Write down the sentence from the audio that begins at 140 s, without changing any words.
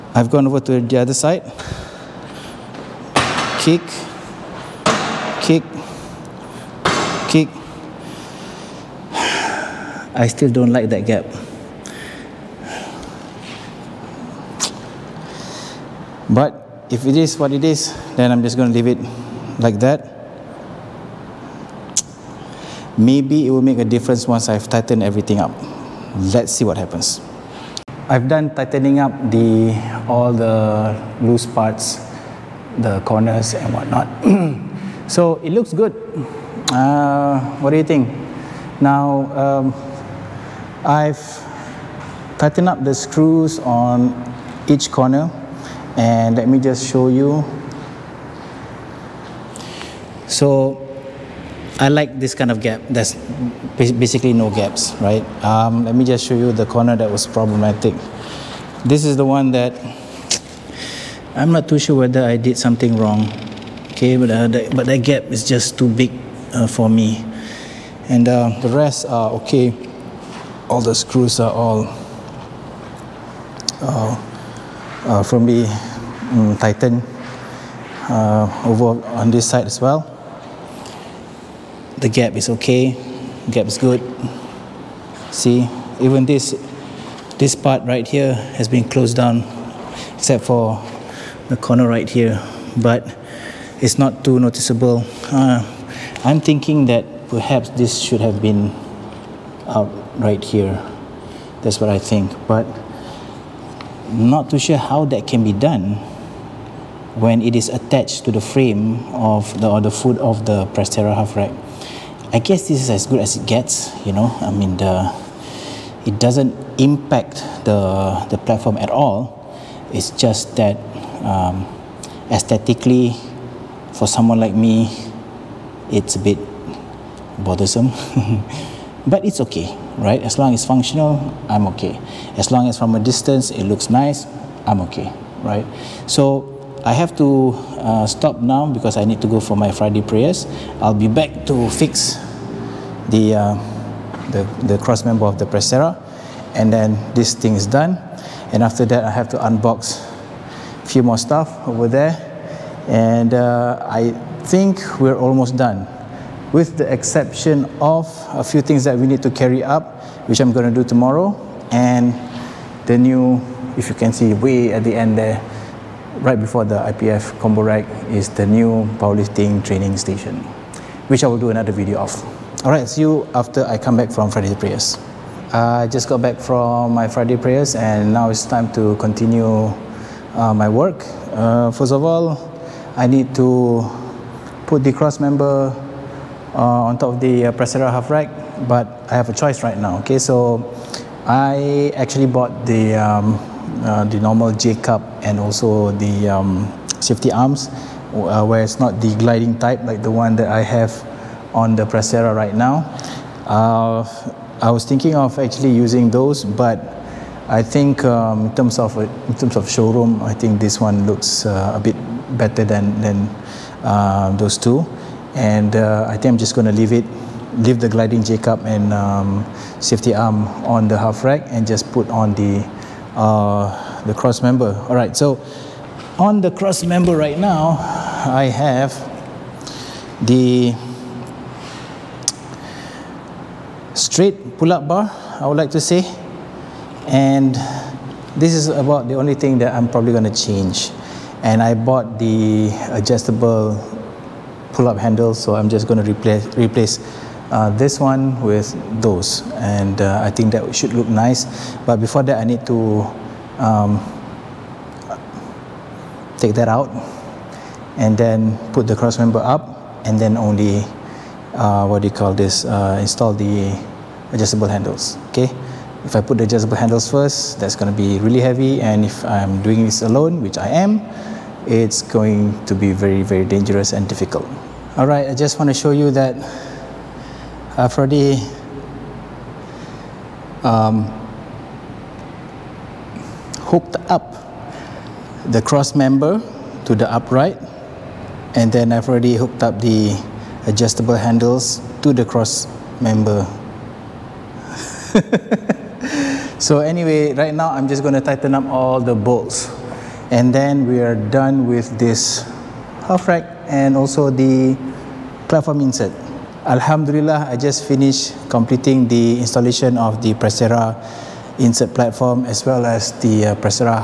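I'll be back to fix the, uh, the, the cross member of the Prestera and then this thing is done.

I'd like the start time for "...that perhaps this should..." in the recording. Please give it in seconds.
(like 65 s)
96 s.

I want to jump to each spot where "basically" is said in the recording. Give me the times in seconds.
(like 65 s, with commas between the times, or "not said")
53 s.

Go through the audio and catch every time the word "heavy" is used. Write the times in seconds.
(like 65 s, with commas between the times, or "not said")
268 s.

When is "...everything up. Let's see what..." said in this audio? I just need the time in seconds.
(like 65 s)
25 s.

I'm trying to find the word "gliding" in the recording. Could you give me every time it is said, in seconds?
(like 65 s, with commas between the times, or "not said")
199 s, 217 s.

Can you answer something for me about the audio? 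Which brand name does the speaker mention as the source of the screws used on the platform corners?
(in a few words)
Titan.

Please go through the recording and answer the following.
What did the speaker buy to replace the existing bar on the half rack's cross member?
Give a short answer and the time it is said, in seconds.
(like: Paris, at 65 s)
adjustable pull-up handle, at 242 s.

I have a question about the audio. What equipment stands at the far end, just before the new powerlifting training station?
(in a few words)
IPF combo rack.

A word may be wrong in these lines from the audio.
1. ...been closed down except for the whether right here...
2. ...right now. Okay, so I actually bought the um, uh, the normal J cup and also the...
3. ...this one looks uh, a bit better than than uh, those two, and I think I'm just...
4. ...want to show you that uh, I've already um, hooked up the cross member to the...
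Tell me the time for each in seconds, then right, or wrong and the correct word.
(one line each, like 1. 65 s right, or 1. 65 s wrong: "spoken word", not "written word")
1. 88 s wrong: "corner", not "whether"
2. 189 s right
3. 210 s right
4. 275 s right.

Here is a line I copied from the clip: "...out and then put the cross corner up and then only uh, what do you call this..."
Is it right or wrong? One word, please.
wrong.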